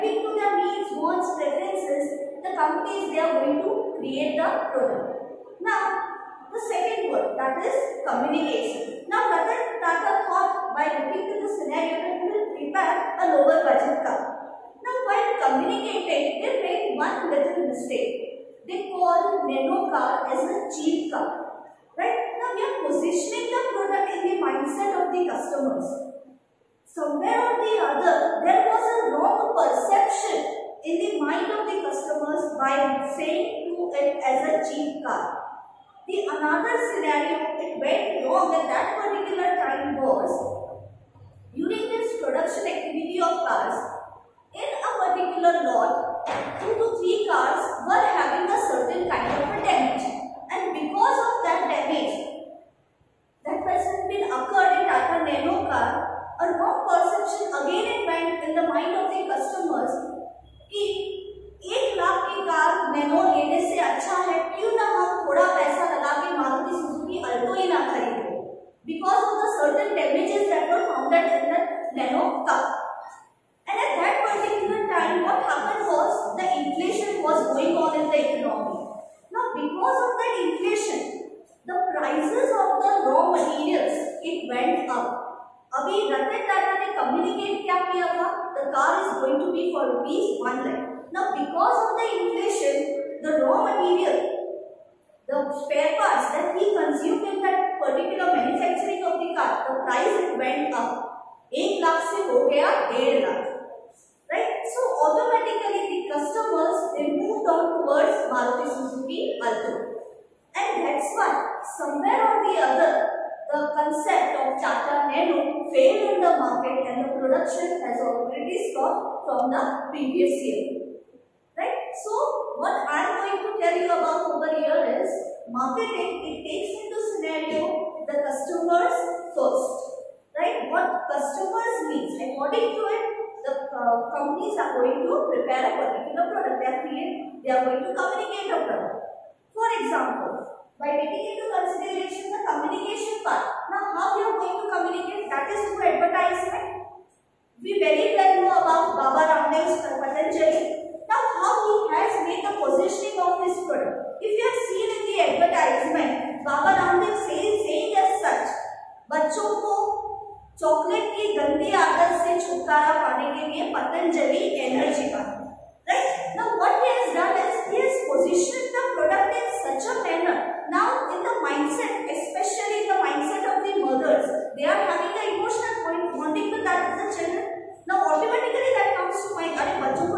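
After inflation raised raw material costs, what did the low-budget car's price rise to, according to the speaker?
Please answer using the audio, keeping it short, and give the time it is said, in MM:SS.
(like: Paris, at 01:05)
1.5 lakh, at 01:42.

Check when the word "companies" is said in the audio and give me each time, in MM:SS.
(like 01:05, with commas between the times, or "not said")
00:02, 02:14.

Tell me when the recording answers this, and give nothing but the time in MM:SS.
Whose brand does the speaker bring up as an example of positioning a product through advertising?
02:29.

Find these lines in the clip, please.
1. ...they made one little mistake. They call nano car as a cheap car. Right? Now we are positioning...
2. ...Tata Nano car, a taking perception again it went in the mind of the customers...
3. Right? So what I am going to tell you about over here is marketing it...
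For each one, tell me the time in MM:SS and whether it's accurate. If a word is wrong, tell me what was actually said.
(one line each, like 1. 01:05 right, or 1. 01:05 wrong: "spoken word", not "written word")
1. 00:16 right
2. 00:54 wrong: "wrong", not "taking"
3. 02:01 right.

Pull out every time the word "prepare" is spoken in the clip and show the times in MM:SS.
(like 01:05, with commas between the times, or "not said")
00:12, 02:15.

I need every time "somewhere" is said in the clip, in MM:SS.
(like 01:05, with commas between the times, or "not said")
00:26, 01:51.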